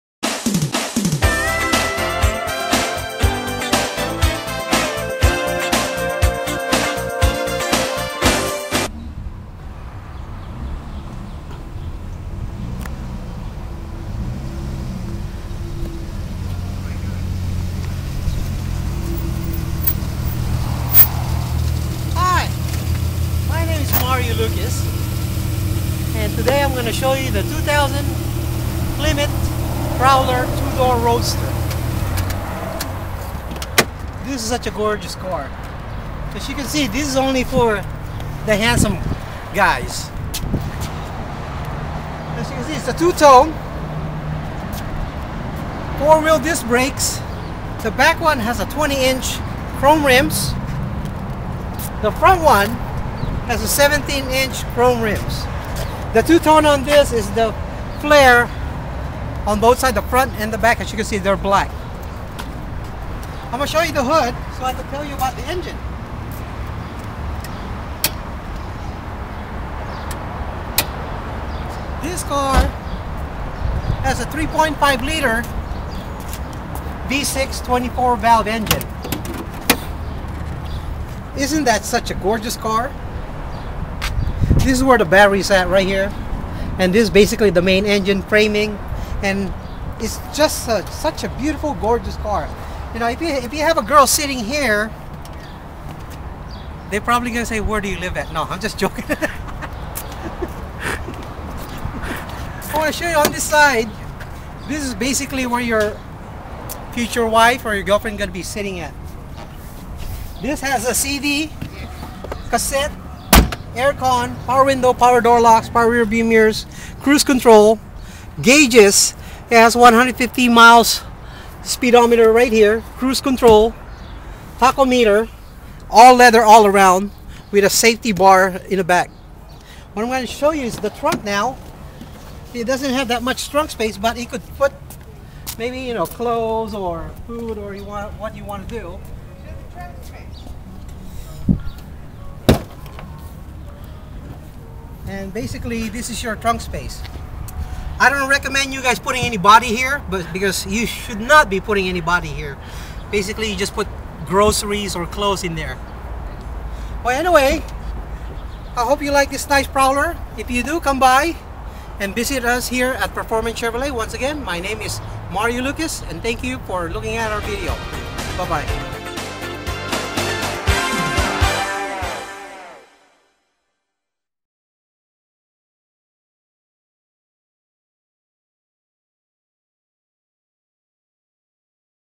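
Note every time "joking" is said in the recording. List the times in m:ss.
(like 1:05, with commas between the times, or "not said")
1:38.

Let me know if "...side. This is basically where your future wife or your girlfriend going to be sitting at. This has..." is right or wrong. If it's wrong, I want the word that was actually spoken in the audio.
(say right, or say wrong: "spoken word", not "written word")
right.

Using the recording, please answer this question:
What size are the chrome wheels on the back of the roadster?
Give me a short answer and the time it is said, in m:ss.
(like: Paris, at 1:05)
20-inch, at 0:48.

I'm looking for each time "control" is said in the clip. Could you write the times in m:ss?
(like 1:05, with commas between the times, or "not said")
1:57, 2:03.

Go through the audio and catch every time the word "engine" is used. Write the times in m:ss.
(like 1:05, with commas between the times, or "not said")
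1:05, 1:18, 1:27.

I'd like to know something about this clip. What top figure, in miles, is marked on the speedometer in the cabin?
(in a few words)
150.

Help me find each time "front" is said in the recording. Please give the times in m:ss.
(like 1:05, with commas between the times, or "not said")
0:52, 1:00.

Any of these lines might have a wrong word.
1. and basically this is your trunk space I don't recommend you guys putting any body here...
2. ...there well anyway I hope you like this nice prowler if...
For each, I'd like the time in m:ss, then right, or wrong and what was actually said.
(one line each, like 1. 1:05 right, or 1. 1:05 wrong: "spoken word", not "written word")
1. 2:25 right
2. 2:35 right.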